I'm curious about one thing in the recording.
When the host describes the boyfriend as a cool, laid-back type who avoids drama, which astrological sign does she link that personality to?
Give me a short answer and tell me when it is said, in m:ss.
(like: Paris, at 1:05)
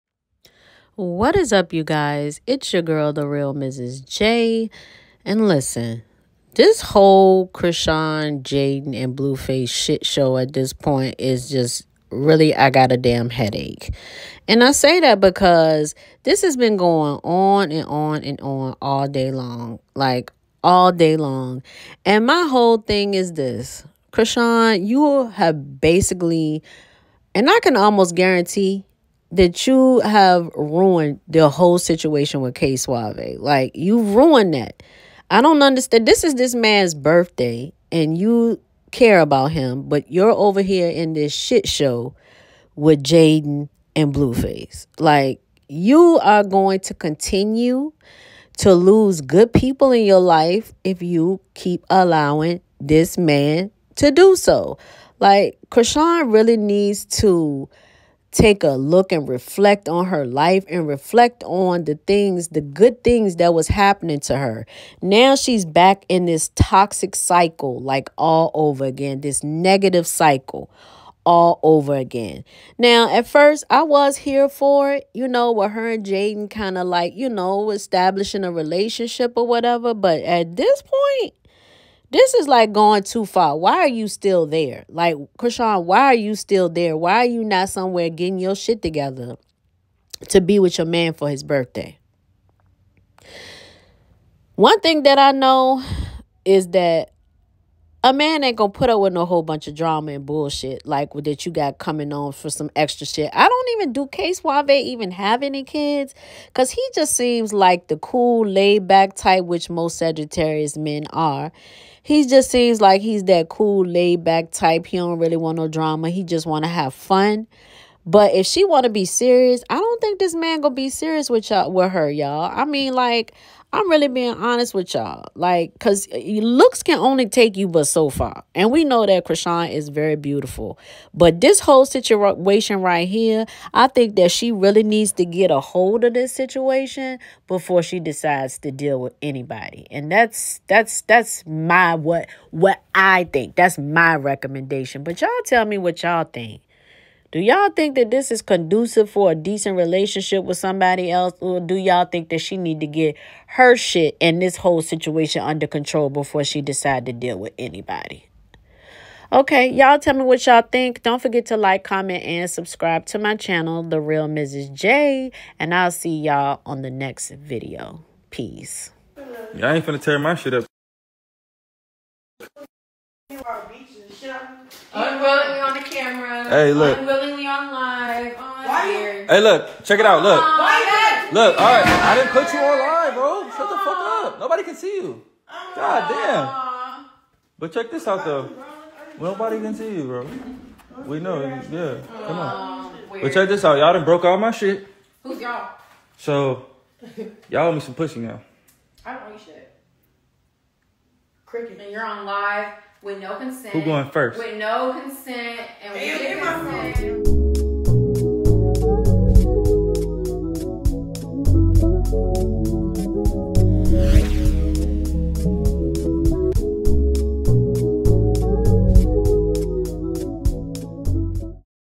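Sagittarius, at 1:49.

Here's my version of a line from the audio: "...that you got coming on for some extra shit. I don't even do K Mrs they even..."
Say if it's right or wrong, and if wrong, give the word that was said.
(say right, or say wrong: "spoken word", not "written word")
wrong: "Suave", not "Mrs".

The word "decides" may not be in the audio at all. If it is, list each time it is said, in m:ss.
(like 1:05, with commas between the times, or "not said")
2:18, 2:36.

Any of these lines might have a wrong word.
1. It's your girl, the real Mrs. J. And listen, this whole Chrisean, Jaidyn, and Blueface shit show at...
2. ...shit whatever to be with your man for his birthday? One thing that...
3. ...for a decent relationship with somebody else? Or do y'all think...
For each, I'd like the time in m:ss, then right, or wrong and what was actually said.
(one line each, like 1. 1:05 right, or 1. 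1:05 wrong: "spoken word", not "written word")
1. 0:02 right
2. 1:28 wrong: "together", not "whatever"
3. 2:29 right.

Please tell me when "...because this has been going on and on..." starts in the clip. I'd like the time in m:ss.
0:15.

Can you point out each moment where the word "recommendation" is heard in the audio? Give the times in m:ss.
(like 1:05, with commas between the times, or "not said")
2:24.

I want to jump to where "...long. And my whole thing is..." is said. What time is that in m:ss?
0:21.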